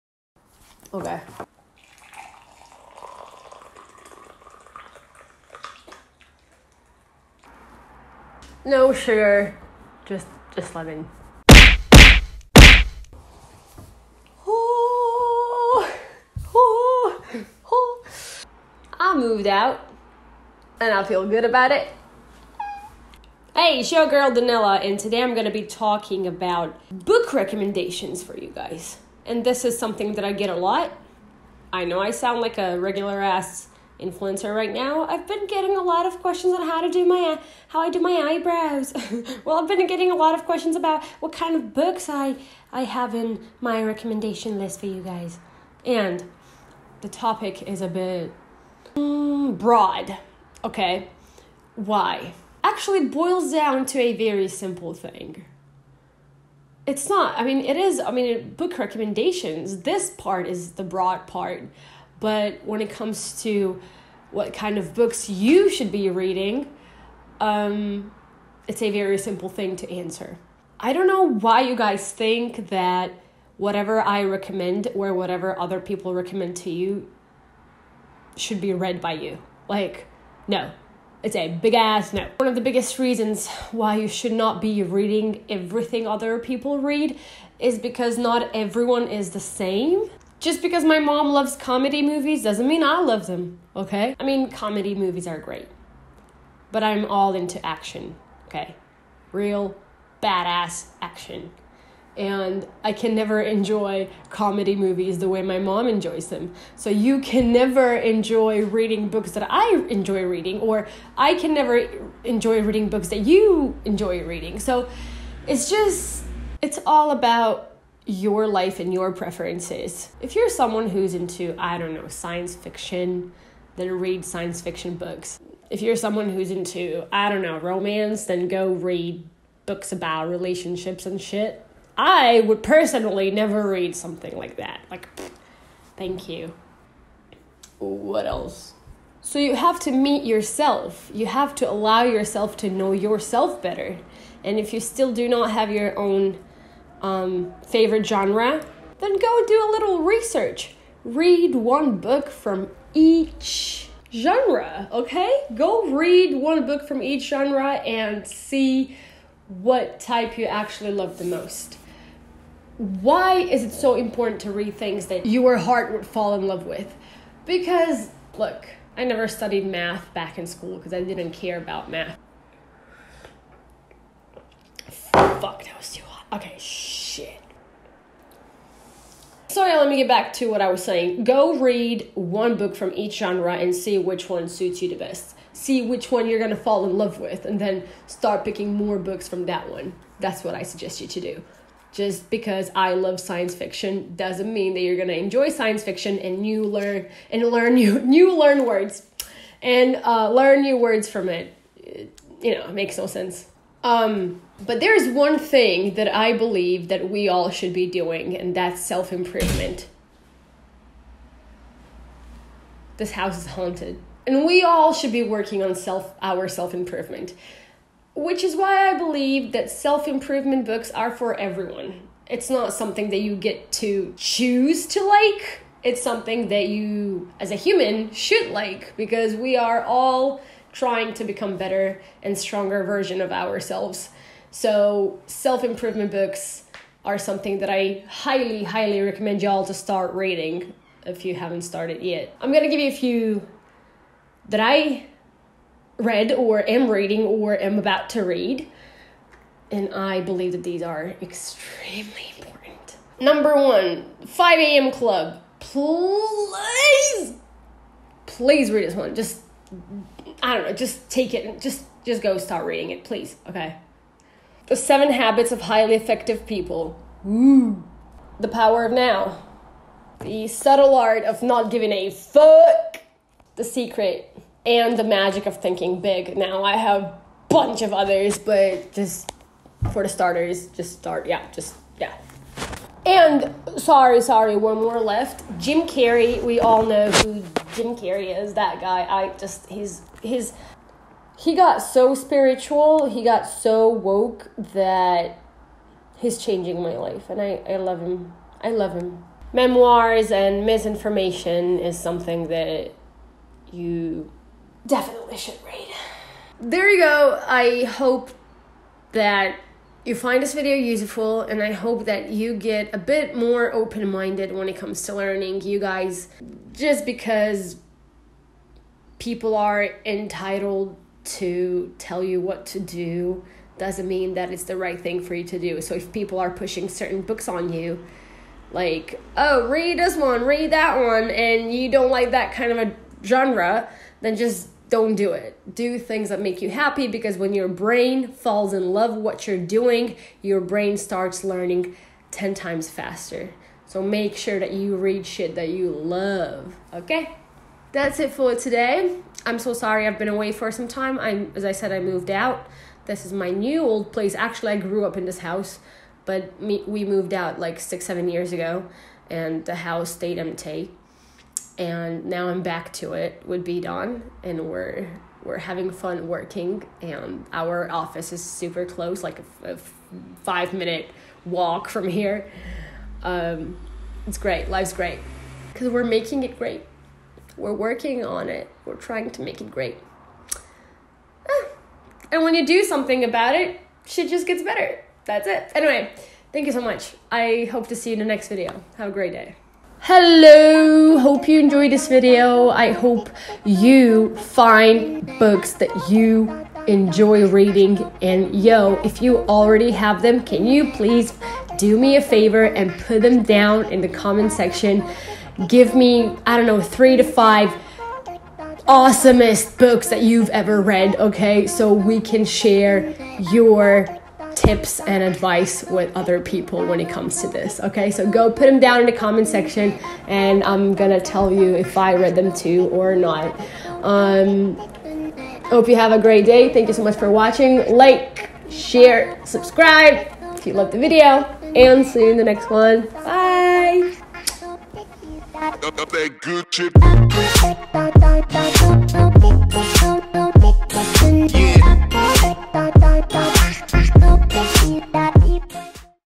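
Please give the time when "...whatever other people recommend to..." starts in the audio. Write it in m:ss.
1:15.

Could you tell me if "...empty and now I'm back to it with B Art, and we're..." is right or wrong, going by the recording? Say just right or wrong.
wrong.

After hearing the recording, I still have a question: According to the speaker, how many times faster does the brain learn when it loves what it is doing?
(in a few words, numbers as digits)
10 times.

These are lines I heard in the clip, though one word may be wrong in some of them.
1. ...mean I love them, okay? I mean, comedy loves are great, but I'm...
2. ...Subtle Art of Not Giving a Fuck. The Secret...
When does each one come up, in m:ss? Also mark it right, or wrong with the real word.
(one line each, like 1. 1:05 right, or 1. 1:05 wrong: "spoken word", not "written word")
1. 1:32 wrong: "movies", not "loves"
2. 4:30 right.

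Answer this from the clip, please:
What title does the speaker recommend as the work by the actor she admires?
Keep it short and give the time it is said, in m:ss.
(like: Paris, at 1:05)
Memoirs and Misinformation, at 4:59.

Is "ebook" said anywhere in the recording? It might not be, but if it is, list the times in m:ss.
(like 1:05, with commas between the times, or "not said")
not said.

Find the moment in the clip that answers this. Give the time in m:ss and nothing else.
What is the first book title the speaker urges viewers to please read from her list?
4:14.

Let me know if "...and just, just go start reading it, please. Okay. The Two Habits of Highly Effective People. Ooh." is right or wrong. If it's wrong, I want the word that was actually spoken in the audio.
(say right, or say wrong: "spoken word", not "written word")
wrong: "Seven", not "Two".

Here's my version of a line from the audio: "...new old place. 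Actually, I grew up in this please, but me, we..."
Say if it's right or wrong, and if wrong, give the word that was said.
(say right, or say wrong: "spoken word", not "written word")
wrong: "house", not "please".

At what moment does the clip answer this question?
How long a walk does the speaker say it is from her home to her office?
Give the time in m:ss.
6:10.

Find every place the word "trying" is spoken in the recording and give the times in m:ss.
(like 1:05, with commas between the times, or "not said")
3:50, 6:18.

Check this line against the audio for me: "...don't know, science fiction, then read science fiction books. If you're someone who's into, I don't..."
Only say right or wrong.
right.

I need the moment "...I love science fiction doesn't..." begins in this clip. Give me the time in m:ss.
3:12.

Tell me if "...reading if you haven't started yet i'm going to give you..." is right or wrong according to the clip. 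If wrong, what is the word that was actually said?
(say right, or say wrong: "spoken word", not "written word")
right.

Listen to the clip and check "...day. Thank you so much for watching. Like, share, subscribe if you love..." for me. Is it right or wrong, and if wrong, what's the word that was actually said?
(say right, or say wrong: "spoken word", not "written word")
right.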